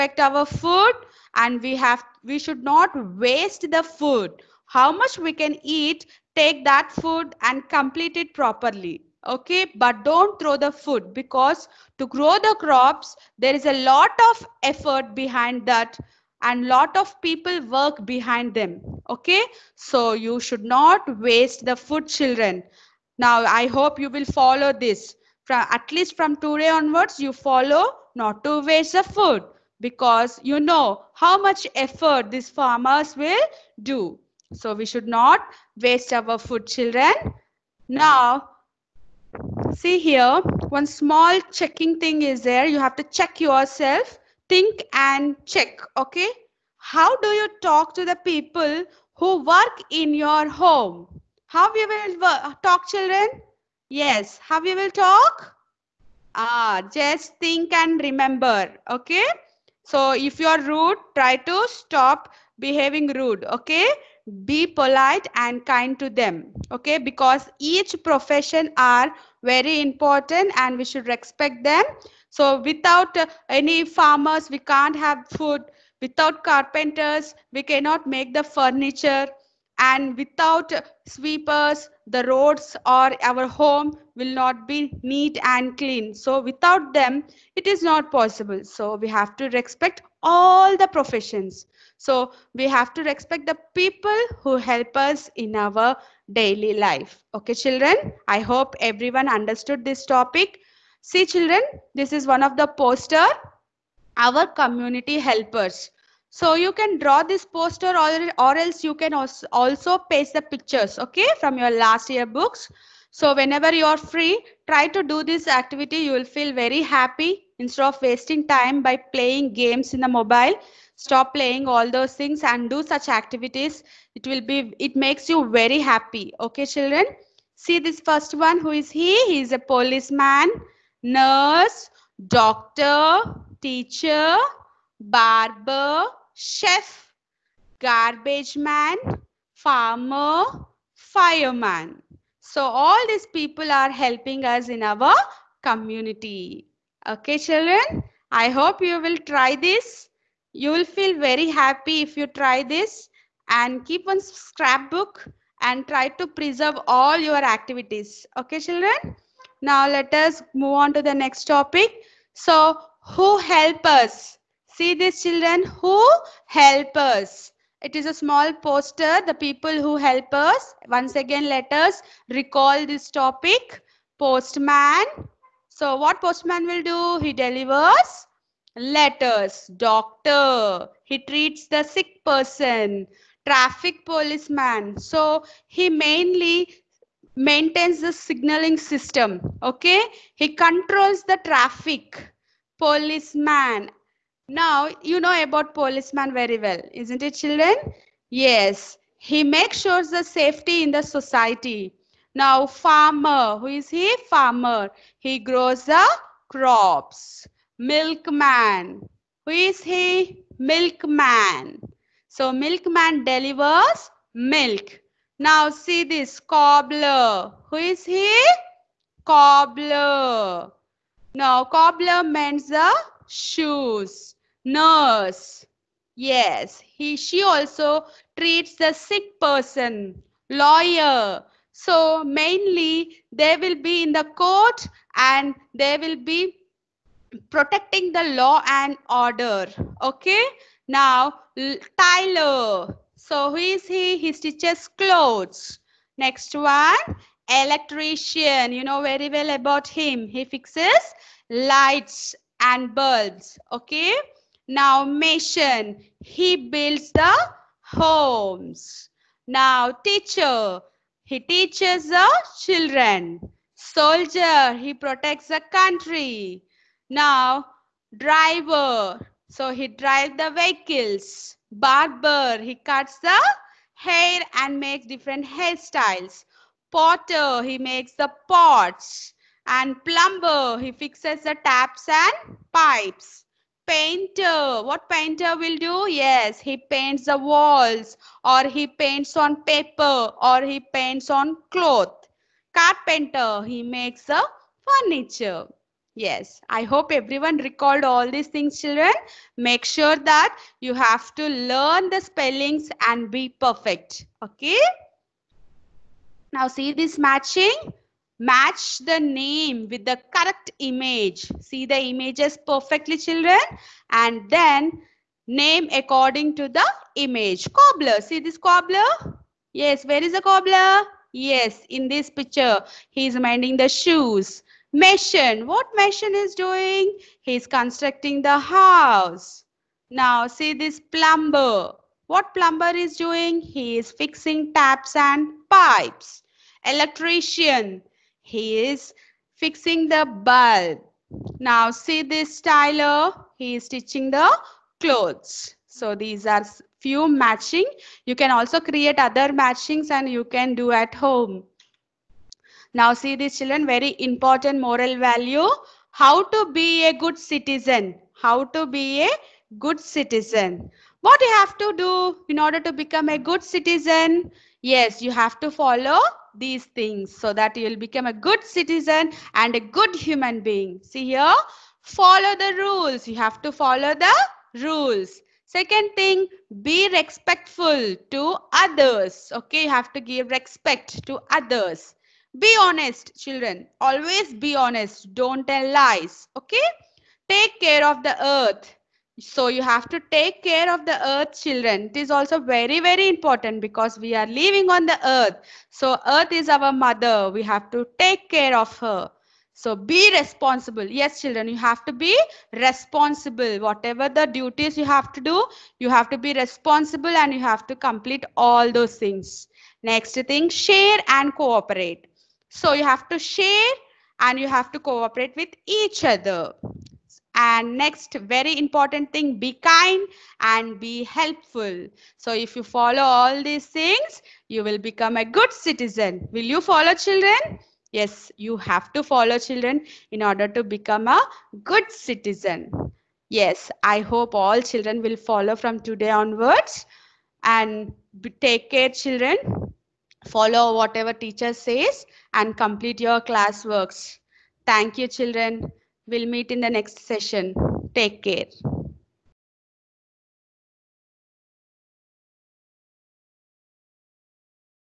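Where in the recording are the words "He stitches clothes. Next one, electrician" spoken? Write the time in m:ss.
4:04.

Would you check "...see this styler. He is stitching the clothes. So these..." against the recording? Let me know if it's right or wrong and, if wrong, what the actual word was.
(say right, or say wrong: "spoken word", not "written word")
right.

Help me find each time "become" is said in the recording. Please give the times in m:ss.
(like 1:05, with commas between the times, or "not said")
6:02, 6:07, 7:05, 7:10.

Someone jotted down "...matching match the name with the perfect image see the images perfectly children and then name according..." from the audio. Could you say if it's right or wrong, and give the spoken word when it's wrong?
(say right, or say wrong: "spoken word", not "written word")
wrong: "correct", not "perfect".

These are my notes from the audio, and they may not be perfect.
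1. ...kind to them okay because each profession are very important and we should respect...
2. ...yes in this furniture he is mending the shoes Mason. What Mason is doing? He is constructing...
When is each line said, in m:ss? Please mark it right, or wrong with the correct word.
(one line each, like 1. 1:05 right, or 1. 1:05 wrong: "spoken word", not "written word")
1. 1:05 right
2. 5:21 wrong: "picture", not "furniture".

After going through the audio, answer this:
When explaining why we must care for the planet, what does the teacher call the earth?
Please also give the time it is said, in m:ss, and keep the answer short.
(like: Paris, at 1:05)
our mother, at 6:36.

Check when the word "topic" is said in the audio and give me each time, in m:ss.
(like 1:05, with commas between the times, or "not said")
1:40, 2:41, 2:53.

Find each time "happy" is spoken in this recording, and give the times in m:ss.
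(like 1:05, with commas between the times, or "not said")
1:56, 2:05, 2:31.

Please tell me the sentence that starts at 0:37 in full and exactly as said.
Now, see here, one small checking thing is there.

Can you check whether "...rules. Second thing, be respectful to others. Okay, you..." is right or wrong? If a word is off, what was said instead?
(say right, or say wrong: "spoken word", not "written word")
right.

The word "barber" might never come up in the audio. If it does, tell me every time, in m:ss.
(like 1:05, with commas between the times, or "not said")
2:15, 4:31.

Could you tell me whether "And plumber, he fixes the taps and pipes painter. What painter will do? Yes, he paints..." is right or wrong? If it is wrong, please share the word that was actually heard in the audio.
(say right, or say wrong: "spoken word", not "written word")
right.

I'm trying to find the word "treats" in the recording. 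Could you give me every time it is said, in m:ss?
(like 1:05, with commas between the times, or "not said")
3:01, 3:48.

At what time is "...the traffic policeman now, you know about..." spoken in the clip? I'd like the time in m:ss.
3:11.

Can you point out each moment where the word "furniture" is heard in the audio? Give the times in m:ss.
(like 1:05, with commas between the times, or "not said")
1:18, 4:54.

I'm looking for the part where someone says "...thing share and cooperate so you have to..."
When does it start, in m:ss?
6:50.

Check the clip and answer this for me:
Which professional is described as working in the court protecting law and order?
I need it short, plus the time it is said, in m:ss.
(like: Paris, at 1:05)
Lawyer, at 3:50.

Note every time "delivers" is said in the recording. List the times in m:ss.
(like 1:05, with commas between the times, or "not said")
2:57, 3:33.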